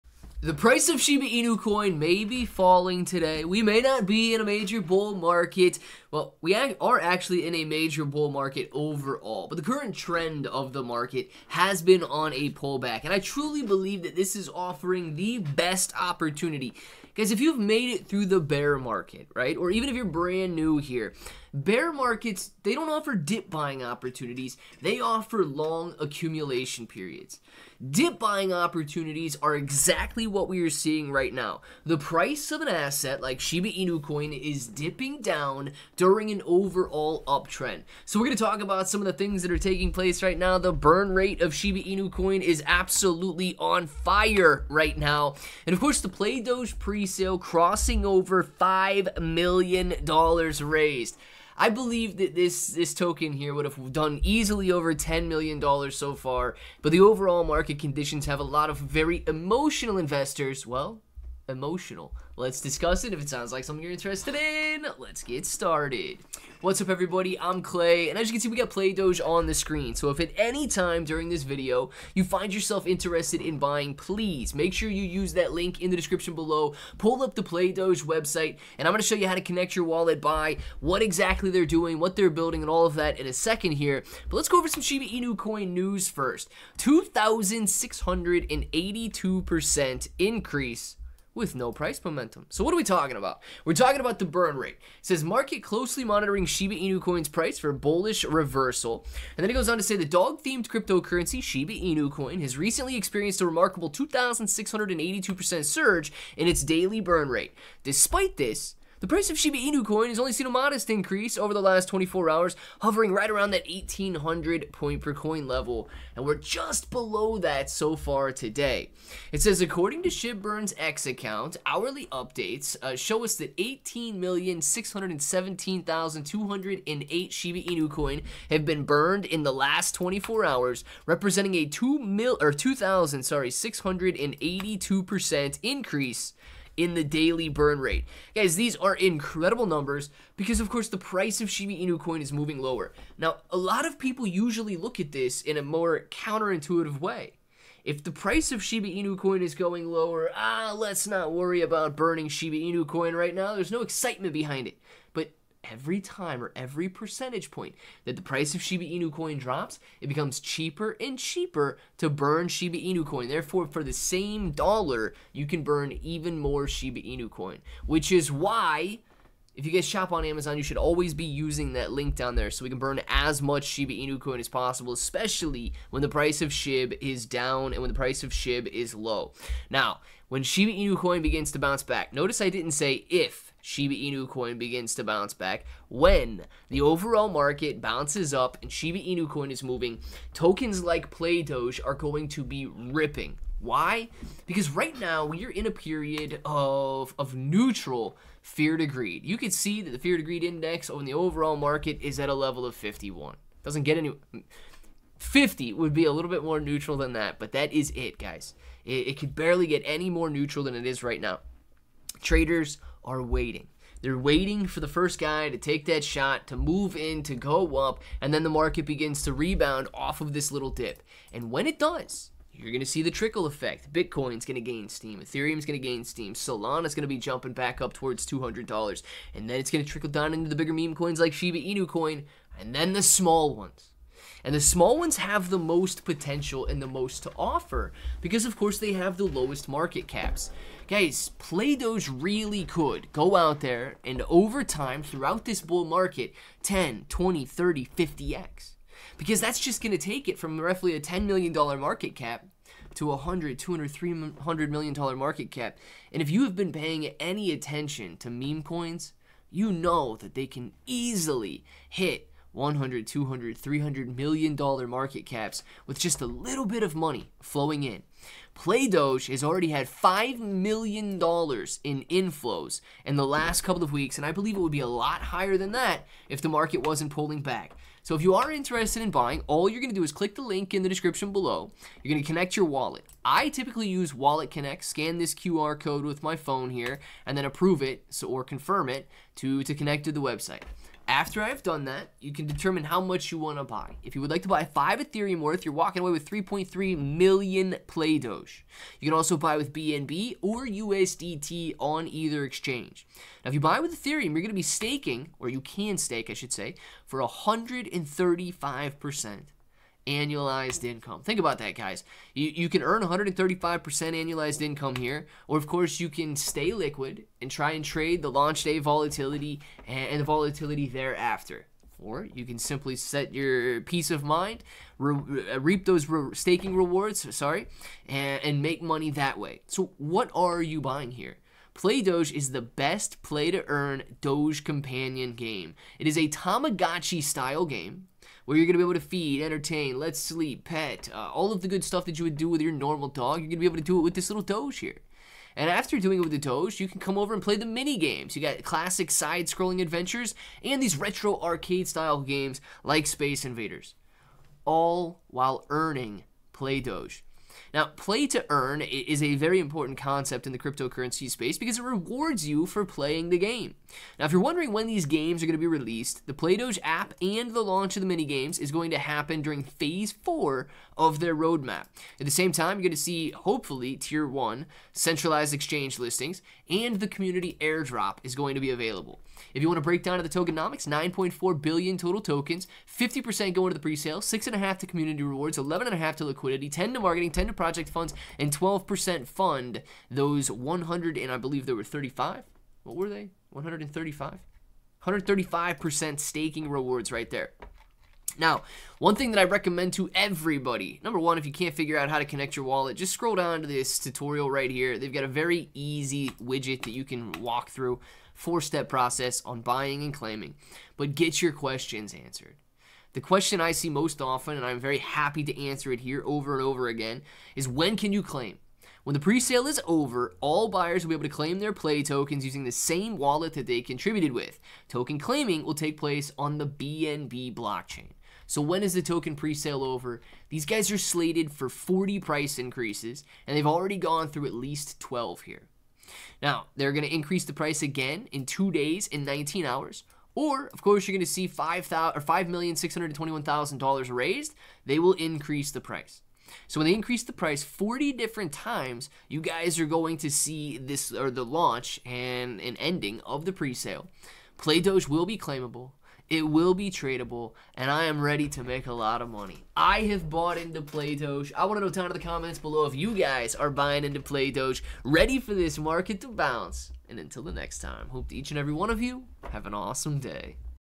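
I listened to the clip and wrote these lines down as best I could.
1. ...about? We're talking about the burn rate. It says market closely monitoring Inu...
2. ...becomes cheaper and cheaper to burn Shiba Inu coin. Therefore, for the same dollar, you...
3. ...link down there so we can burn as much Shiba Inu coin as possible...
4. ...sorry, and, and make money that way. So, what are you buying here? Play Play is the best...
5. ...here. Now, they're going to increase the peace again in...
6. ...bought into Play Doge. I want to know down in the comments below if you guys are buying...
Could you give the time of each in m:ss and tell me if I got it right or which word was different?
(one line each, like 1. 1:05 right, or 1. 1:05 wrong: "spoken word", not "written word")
1. 1:33 wrong: "Shiba", not "Inu"
2. 2:40 right
3. 2:51 right
4. 5:27 wrong: "Doge", not "Play"
5. 7:15 wrong: "price", not "peace"
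6. 7:40 right.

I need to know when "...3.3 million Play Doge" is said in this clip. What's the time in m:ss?
4:56.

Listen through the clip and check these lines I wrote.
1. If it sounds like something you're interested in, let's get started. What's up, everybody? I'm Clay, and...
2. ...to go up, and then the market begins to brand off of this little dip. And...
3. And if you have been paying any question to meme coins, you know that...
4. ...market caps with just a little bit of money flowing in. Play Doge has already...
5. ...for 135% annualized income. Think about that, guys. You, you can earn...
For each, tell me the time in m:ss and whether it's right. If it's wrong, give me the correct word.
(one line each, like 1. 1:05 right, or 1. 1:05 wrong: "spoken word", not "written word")
1. 1:03 right
2. 3:37 wrong: "rebound", not "brand"
3. 4:16 wrong: "attention", not "question"
4. 4:24 right
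5. 5:07 right.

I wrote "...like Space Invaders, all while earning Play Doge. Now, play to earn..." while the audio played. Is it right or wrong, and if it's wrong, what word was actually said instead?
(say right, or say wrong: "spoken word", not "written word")
right.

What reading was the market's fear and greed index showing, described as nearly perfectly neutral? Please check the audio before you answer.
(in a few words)
51.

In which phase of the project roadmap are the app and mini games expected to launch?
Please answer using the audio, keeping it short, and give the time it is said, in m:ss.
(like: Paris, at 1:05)
Phase four, at 6:09.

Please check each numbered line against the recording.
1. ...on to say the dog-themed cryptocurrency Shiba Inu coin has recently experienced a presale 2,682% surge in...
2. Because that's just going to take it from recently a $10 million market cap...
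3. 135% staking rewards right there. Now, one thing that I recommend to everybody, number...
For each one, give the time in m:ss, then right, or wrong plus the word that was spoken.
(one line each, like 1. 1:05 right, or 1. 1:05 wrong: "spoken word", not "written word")
1. 1:39 wrong: "remarkable", not "presale"
2. 4:09 wrong: "roughly", not "recently"
3. 6:35 right.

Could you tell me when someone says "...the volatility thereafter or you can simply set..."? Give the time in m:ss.
5:20.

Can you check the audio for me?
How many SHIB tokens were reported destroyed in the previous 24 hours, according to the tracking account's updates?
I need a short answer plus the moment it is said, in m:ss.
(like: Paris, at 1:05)
18,617,208, at 2:03.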